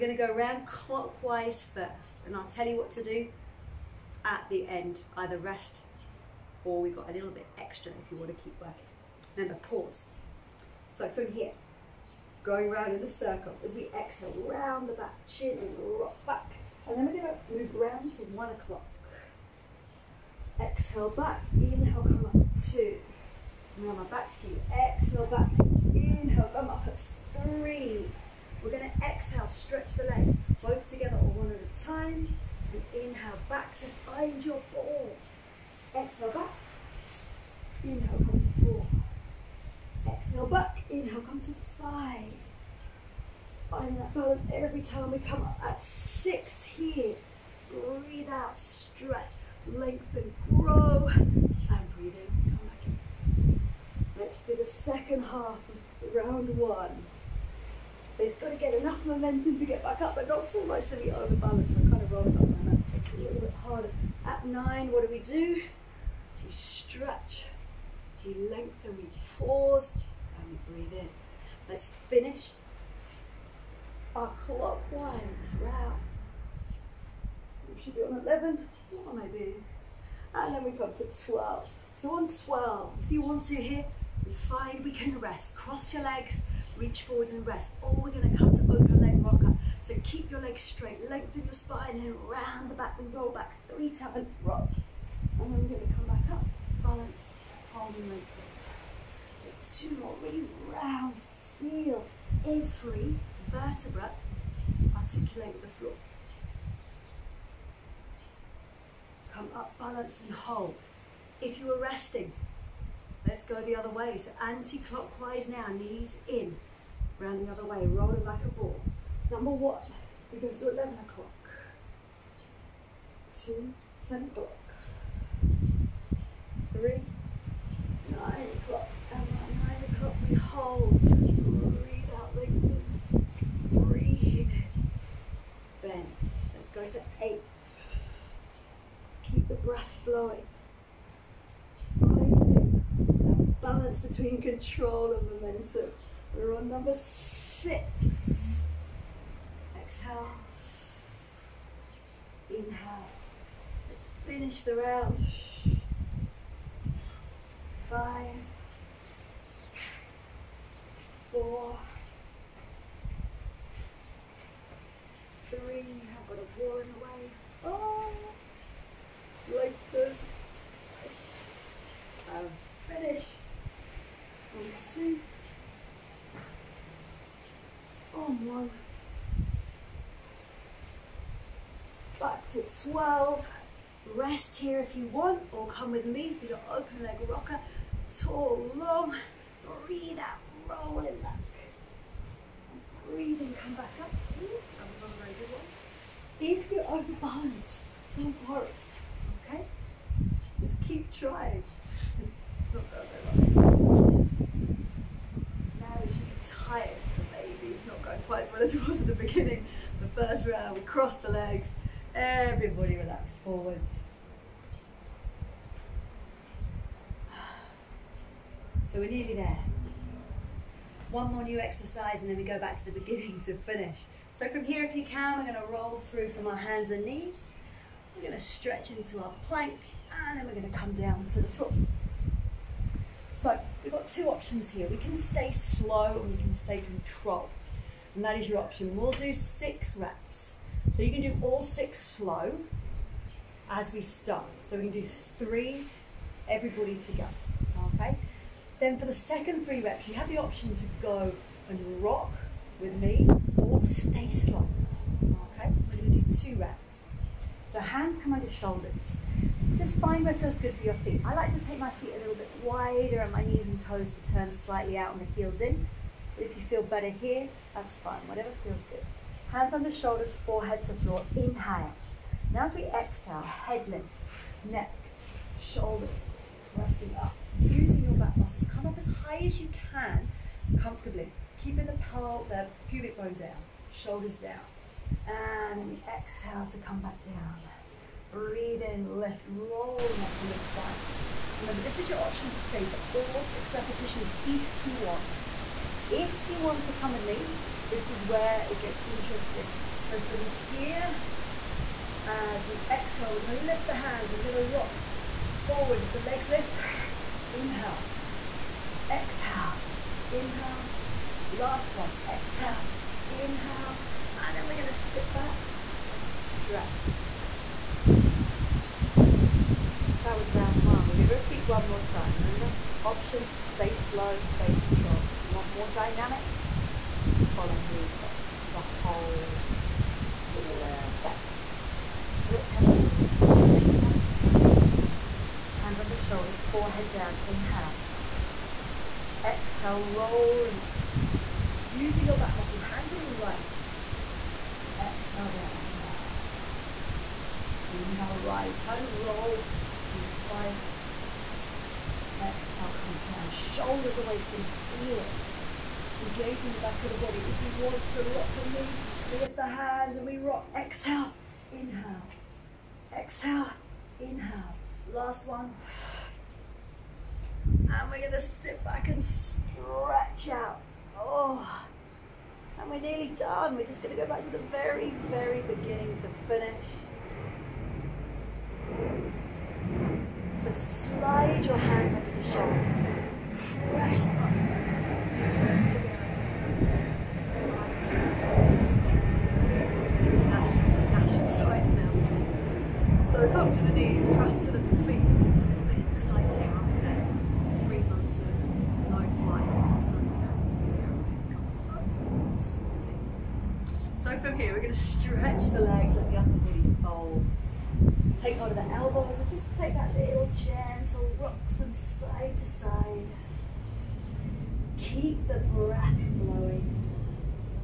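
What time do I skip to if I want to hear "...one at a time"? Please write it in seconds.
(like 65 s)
31 s.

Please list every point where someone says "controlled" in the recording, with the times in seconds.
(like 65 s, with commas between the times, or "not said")
236 s, 324 s.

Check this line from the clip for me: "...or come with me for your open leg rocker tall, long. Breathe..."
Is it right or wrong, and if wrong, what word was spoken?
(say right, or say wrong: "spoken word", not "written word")
right.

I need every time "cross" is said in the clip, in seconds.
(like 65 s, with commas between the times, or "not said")
85 s, 210 s.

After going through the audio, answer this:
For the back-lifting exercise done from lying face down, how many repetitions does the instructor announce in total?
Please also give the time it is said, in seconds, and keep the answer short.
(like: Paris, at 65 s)
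6, at 239 s.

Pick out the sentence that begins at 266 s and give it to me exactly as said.
But if you feel better here, that's fine, whatever feels good.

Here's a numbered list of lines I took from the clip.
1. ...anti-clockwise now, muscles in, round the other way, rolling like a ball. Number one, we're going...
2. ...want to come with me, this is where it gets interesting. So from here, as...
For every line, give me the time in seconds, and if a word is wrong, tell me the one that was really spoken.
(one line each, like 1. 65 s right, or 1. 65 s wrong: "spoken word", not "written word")
1. 114 s wrong: "knees", not "muscles"
2. 296 s right.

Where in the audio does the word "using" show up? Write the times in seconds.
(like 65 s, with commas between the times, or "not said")
277 s, 341 s.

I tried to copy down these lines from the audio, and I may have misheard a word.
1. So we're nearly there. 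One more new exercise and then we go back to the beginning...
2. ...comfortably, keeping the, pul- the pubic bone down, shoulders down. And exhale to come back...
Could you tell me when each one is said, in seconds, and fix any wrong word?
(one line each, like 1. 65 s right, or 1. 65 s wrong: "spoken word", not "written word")
1. 218 s right
2. 280 s right.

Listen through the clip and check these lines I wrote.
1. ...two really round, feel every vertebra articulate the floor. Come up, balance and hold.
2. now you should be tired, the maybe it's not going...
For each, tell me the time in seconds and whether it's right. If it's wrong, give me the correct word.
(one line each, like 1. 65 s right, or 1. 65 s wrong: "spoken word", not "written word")
1. 99 s right
2. 202 s right.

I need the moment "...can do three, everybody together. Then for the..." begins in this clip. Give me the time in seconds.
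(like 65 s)
244 s.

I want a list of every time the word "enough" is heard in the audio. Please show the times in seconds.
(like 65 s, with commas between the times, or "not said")
58 s.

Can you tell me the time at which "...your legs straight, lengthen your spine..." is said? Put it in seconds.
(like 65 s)
90 s.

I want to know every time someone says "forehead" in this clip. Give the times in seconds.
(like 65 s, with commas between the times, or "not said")
270 s, 336 s.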